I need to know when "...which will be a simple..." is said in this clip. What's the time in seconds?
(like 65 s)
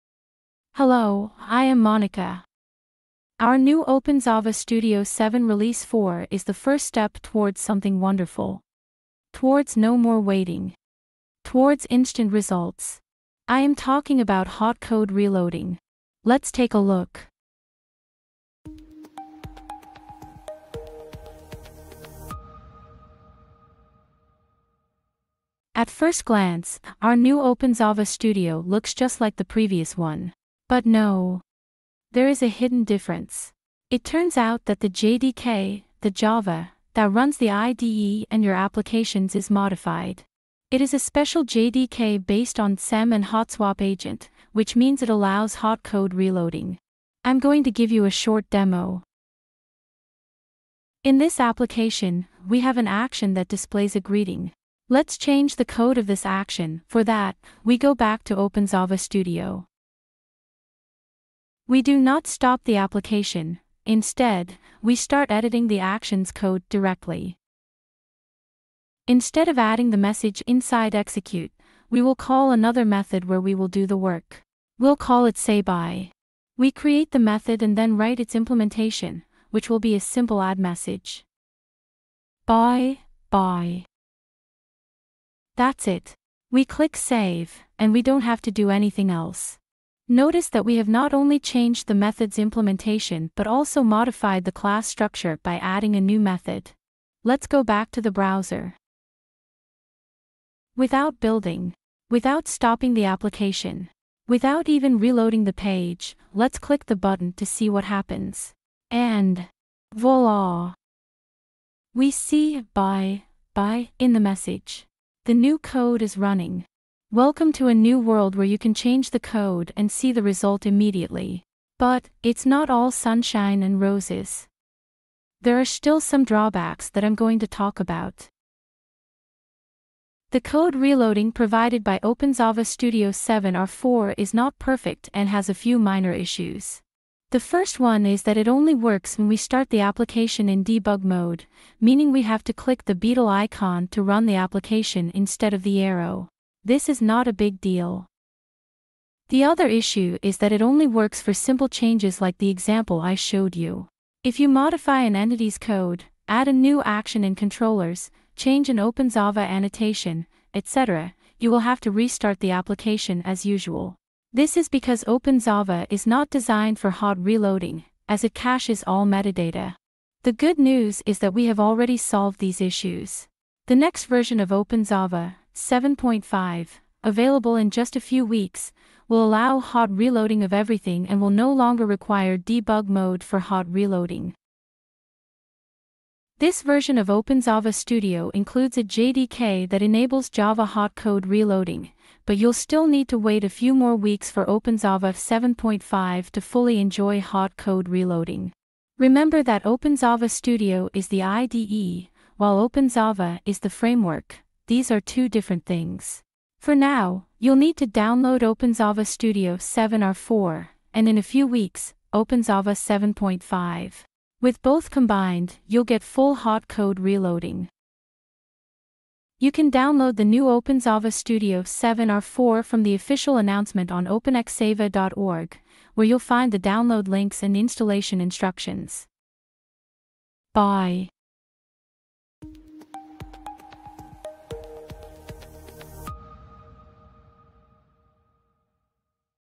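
79 s.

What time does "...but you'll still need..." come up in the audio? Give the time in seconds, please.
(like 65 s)
192 s.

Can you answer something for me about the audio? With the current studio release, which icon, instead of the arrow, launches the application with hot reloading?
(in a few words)
beetle icon.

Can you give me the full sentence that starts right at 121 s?
But, it's not all sunshine and roses.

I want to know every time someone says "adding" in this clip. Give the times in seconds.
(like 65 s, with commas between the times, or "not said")
69 s, 95 s.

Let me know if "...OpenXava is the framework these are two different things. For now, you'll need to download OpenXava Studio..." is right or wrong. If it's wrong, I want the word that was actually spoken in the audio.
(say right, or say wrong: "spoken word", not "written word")
right.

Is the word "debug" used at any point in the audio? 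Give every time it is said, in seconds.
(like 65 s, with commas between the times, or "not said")
140 s, 182 s.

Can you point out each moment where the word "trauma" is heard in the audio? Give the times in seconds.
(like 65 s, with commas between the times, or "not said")
not said.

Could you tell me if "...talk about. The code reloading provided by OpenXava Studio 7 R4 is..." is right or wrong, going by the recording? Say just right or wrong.
right.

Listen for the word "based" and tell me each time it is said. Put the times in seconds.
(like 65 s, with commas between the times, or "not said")
42 s.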